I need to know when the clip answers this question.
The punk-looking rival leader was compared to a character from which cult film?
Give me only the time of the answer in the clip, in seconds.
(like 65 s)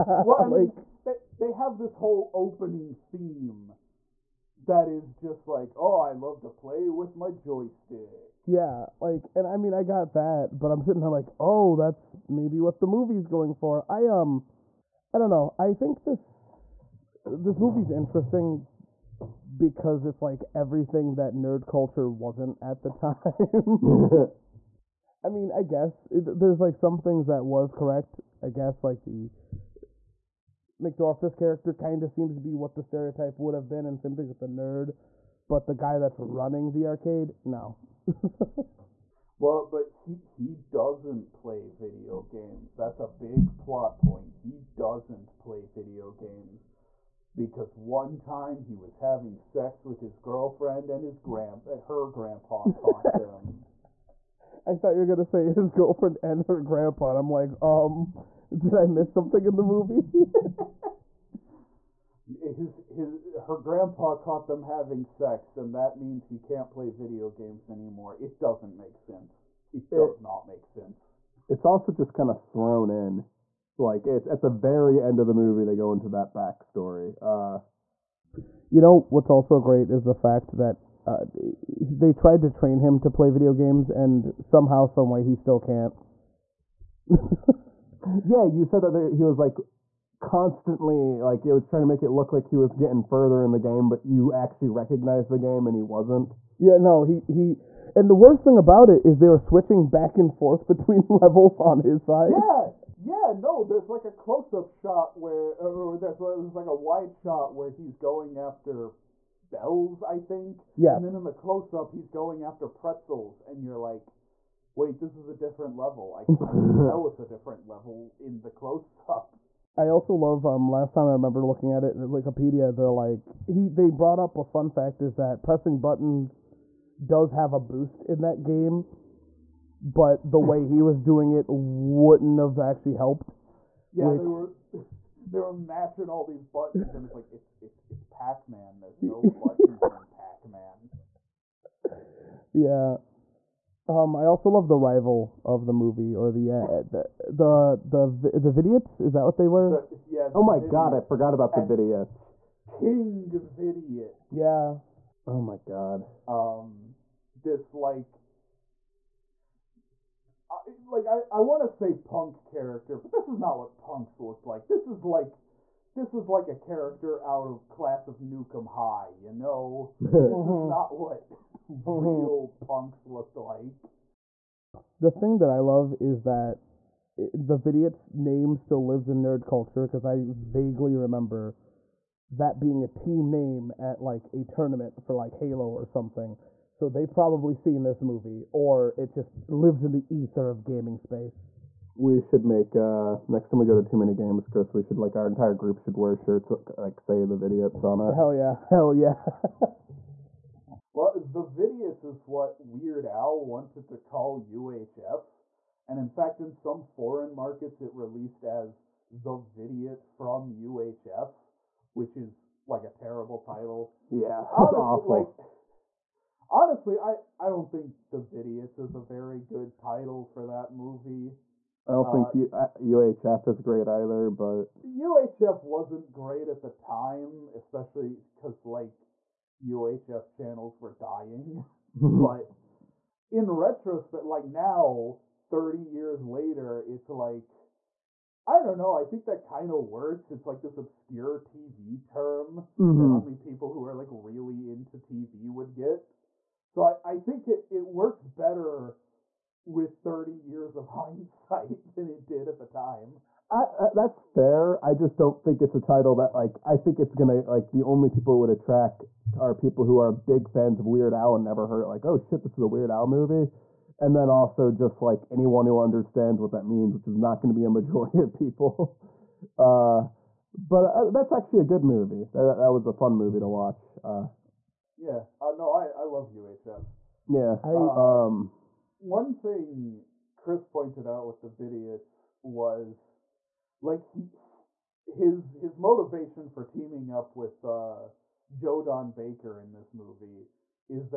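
167 s.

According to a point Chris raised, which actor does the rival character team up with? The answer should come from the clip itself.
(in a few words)
Joe Don Baker.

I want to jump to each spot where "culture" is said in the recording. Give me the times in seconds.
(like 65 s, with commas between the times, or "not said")
21 s, 179 s.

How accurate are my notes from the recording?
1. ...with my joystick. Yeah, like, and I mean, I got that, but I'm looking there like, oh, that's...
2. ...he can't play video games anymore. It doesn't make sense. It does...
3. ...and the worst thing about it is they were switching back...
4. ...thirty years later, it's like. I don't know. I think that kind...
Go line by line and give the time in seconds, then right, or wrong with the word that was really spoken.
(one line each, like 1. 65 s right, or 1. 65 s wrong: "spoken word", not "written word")
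1. 6 s wrong: "sitting", not "looking"
2. 66 s right
3. 97 s right
4. 235 s right.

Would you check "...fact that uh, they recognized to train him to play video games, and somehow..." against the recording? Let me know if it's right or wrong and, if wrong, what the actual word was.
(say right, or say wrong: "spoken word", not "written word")
wrong: "tried", not "recognized".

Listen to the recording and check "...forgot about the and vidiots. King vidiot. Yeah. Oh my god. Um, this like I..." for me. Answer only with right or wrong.
right.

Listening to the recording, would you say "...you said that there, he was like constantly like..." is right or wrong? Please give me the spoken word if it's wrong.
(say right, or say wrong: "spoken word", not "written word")
right.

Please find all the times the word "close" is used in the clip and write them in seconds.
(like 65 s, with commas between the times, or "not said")
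104 s, 111 s, 118 s.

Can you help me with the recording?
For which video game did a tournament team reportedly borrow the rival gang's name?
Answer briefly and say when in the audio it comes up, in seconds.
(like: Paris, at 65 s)
Halo, at 185 s.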